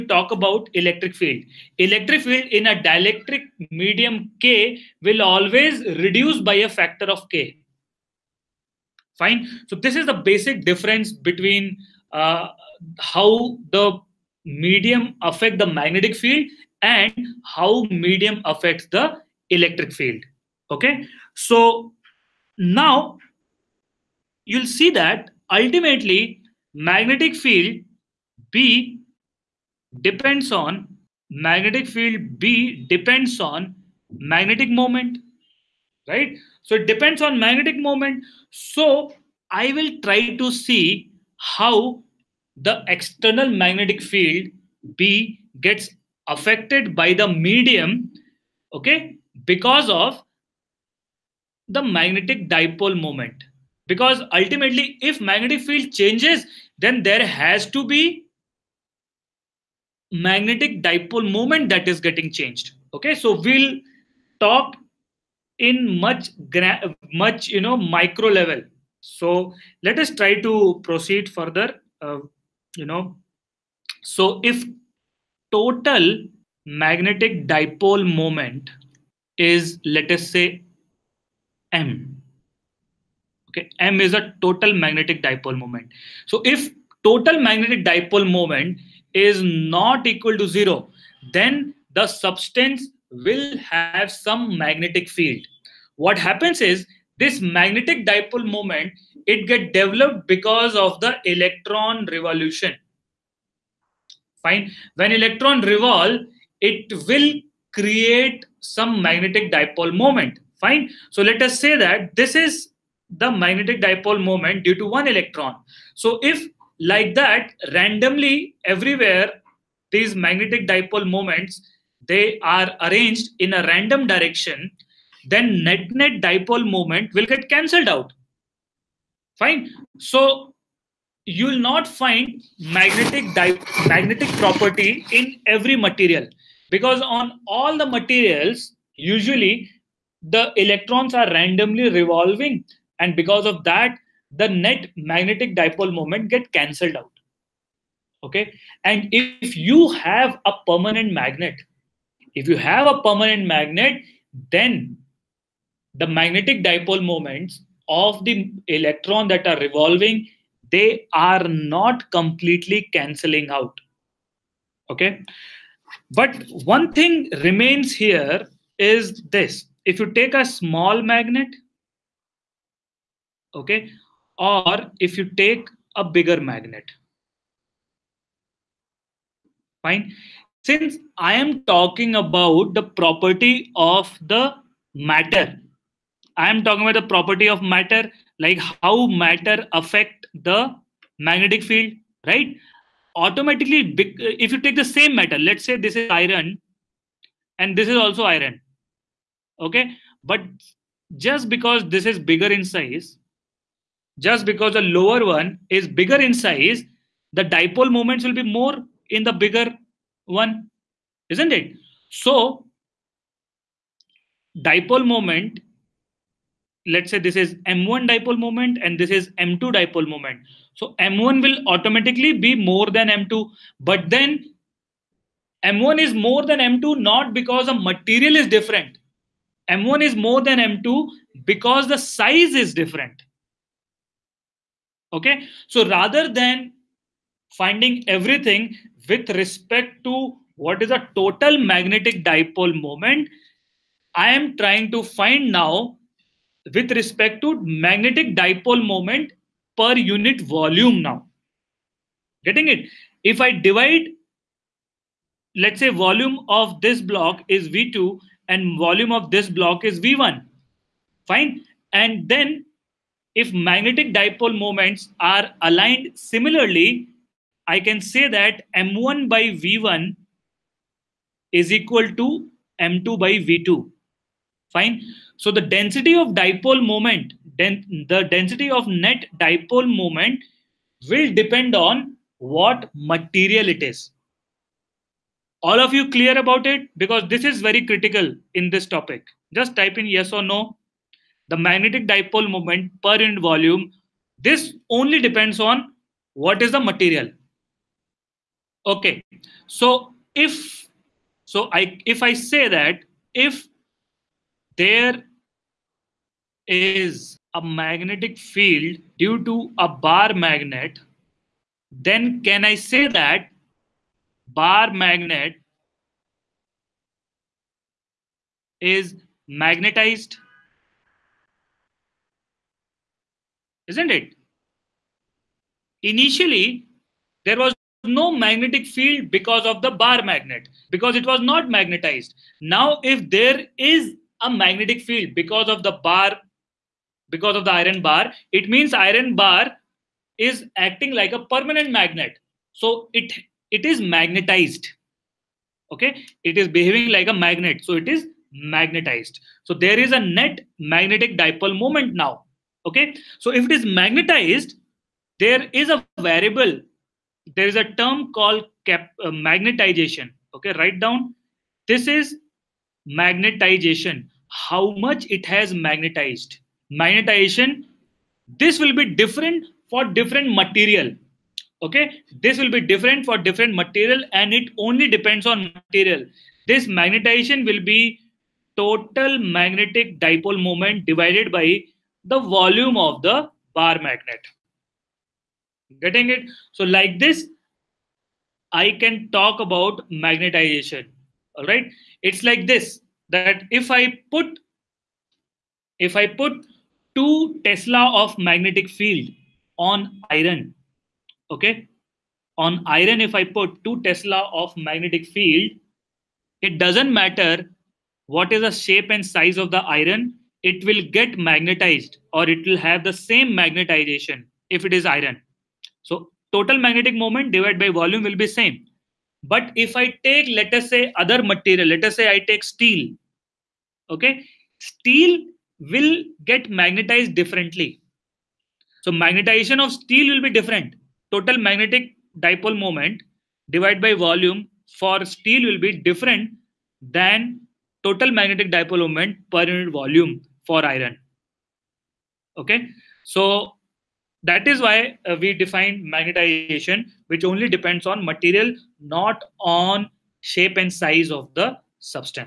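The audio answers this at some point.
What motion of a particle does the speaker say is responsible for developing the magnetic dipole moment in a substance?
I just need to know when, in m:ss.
1:41.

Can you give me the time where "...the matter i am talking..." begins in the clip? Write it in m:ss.
3:04.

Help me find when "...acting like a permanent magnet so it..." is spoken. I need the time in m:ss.
5:40.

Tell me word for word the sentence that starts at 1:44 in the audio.
When electron revolve, it will create some magnetic dipole moment.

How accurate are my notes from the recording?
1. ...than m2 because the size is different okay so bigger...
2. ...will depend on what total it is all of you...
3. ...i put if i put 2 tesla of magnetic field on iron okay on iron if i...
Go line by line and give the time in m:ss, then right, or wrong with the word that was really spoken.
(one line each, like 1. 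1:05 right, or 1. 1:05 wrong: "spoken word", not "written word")
1. 3:50 wrong: "rather", not "bigger"
2. 4:41 wrong: "material", not "total"
3. 6:33 right.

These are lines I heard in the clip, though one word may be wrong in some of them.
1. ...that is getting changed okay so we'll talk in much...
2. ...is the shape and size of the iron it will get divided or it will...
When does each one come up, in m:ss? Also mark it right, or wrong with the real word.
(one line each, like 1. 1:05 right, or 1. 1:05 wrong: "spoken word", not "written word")
1. 1:01 right
2. 6:48 wrong: "magnetized", not "divided".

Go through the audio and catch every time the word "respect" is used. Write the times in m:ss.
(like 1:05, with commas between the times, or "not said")
3:59, 4:06.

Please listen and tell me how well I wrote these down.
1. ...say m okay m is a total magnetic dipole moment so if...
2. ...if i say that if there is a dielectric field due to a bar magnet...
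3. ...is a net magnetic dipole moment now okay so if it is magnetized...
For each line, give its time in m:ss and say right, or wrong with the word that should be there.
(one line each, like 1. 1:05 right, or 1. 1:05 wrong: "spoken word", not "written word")
1. 1:20 right
2. 5:02 wrong: "magnetic", not "dielectric"
3. 5:49 right.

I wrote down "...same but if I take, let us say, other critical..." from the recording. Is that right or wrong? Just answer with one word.
wrong.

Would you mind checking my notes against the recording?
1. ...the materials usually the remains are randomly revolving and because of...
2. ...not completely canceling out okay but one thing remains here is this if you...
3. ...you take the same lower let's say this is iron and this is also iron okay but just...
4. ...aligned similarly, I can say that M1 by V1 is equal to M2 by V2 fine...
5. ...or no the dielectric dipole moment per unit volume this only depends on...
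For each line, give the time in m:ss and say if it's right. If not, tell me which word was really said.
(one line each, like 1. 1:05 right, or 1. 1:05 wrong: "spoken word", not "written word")
1. 2:17 wrong: "electrons", not "remains"
2. 2:41 right
3. 3:14 wrong: "matter", not "lower"
4. 4:25 right
5. 4:50 wrong: "magnetic", not "dielectric".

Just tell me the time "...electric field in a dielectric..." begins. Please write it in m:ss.
0:01.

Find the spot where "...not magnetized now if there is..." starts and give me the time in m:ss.
5:31.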